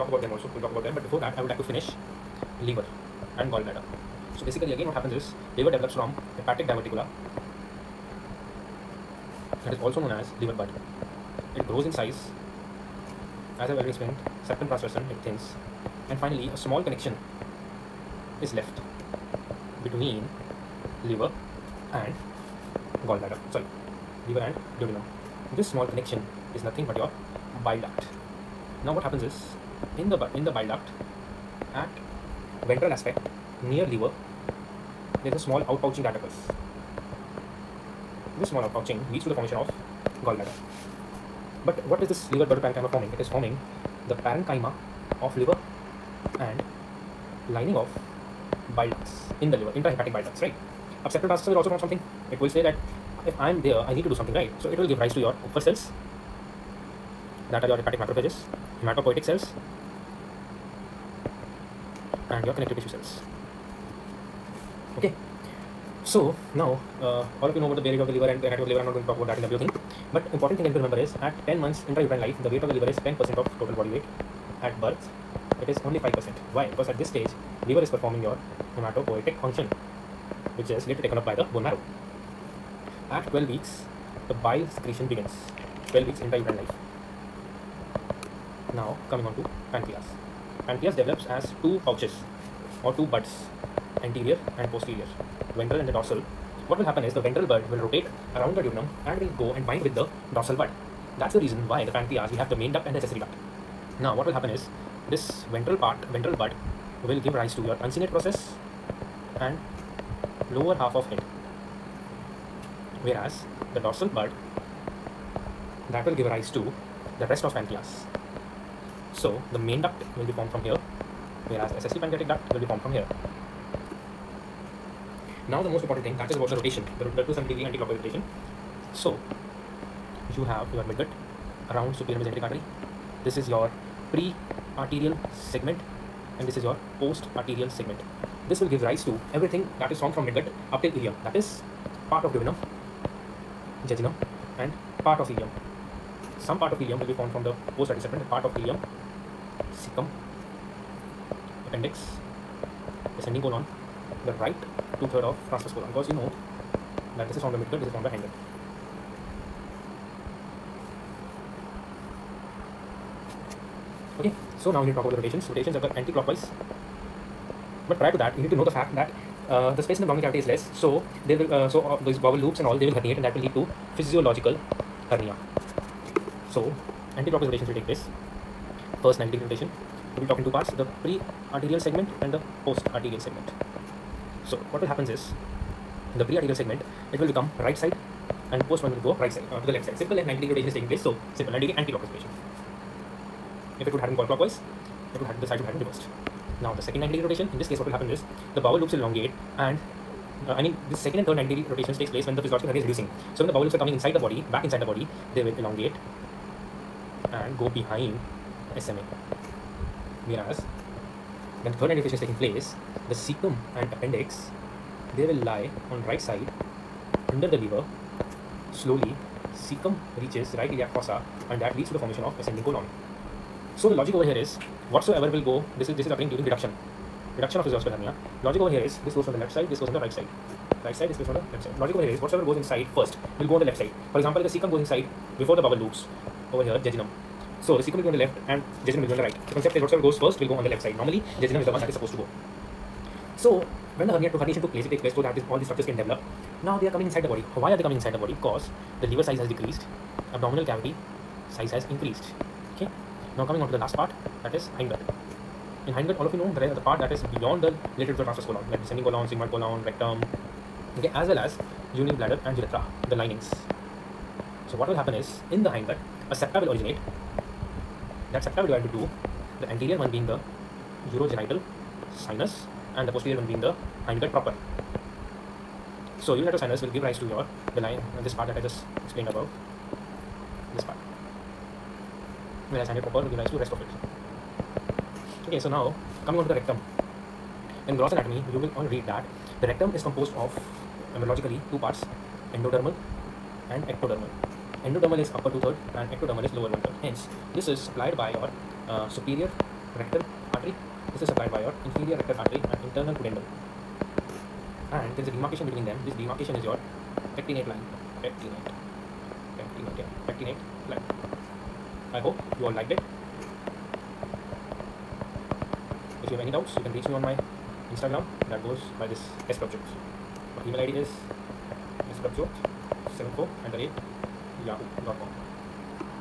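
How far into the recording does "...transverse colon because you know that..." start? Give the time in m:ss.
2:35.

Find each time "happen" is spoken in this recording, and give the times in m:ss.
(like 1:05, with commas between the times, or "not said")
0:04, 0:29, 1:36, 1:44, 3:04, 3:17, 4:24.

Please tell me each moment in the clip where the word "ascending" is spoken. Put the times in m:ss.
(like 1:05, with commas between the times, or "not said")
2:33, 3:42.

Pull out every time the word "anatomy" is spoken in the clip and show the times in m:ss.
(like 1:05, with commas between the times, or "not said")
1:08, 4:48.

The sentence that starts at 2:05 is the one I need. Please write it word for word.
Now the most important thing that is about the rotation, the, the 270 degree anti-clockwise rotation.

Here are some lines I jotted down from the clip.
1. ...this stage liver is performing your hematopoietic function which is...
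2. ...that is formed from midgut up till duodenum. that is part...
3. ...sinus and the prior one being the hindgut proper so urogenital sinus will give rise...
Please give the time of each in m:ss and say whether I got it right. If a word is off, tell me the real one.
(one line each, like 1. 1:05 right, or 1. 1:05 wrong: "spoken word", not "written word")
1. 1:17 right
2. 2:19 wrong: "ileum", not "duodenum"
3. 4:32 wrong: "posterior", not "prior".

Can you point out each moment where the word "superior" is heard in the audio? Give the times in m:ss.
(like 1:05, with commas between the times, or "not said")
2:11, 4:59.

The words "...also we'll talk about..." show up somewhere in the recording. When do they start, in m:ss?
0:00.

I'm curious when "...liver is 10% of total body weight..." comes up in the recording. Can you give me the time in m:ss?
1:12.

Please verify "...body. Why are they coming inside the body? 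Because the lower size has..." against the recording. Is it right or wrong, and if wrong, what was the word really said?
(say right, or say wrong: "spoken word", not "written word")
wrong: "liver", not "lower".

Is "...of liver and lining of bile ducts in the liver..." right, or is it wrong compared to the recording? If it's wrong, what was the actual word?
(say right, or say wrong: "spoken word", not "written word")
right.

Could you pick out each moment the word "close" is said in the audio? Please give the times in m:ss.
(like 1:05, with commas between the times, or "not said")
not said.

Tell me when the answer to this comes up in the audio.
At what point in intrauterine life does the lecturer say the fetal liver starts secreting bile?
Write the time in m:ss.
1:25.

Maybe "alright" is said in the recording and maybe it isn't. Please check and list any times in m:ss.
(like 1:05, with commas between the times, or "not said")
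not said.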